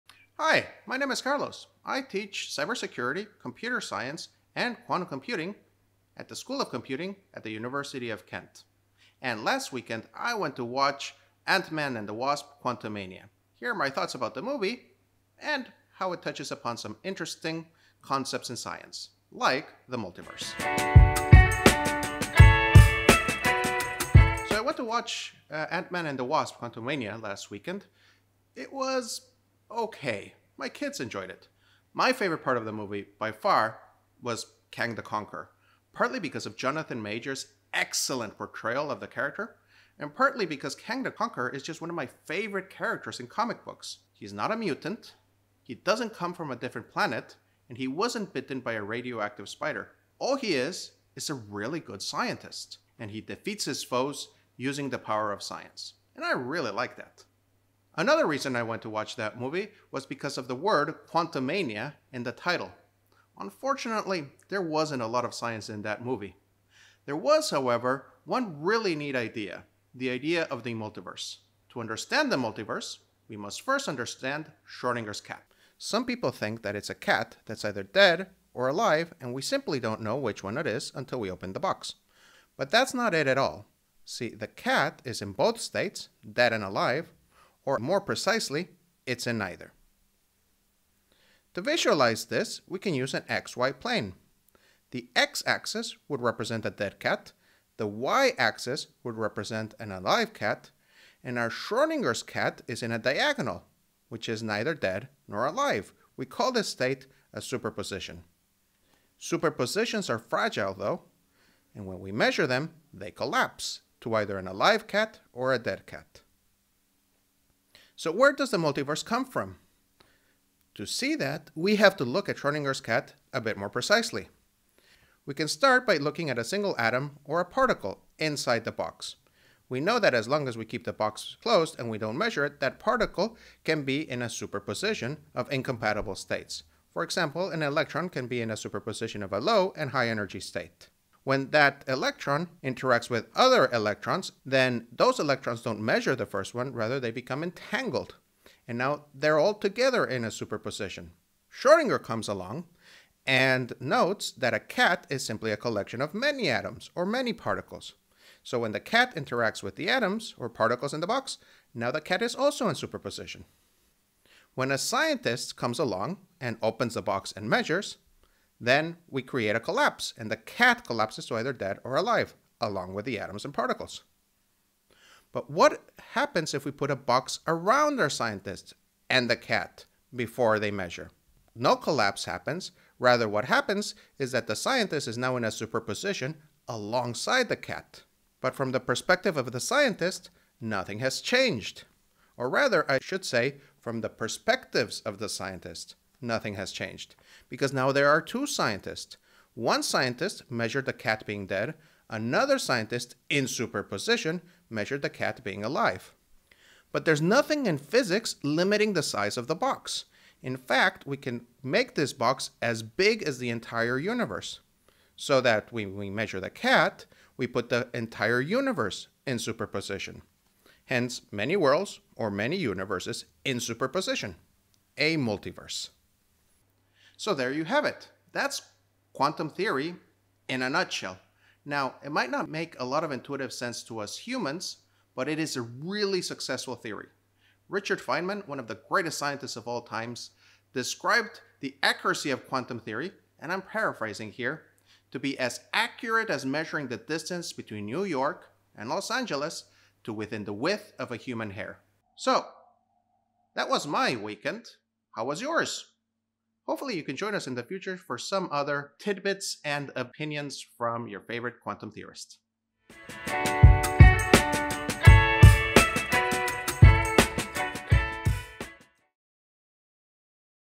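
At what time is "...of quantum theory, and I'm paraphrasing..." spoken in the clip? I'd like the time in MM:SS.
04:02.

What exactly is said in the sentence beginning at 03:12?
Or rather, I should say, from the perspectives of the scientist nothing has changed.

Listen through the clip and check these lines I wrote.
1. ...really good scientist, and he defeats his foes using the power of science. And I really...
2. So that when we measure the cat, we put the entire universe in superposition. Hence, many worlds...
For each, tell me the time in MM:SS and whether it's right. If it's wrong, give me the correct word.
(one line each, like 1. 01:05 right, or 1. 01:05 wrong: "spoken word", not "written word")
1. 00:51 right
2. 03:35 right.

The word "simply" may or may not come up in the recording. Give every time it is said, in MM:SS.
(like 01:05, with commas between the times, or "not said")
01:19, 02:35.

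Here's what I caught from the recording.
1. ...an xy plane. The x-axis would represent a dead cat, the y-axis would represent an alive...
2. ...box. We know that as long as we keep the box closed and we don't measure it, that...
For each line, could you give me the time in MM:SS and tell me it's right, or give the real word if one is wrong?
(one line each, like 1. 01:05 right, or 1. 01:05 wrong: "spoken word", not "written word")
1. 01:33 right
2. 02:08 right.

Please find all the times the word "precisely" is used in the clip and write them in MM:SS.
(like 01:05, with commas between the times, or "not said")
01:28, 02:03.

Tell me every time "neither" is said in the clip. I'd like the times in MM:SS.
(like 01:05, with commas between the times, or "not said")
01:29, 01:44.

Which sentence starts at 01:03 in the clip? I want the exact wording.
Unfortunately, there wasn't a lot of science in that movie.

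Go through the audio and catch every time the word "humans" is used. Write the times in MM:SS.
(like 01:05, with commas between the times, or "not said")
03:54, 04:11.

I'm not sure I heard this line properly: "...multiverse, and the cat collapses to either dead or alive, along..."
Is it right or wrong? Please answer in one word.
wrong.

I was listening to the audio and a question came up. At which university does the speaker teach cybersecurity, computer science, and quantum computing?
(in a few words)
University of Kent.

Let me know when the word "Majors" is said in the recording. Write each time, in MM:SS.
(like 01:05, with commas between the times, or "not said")
00:37.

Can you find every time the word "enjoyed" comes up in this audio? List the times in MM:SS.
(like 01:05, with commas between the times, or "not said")
00:30.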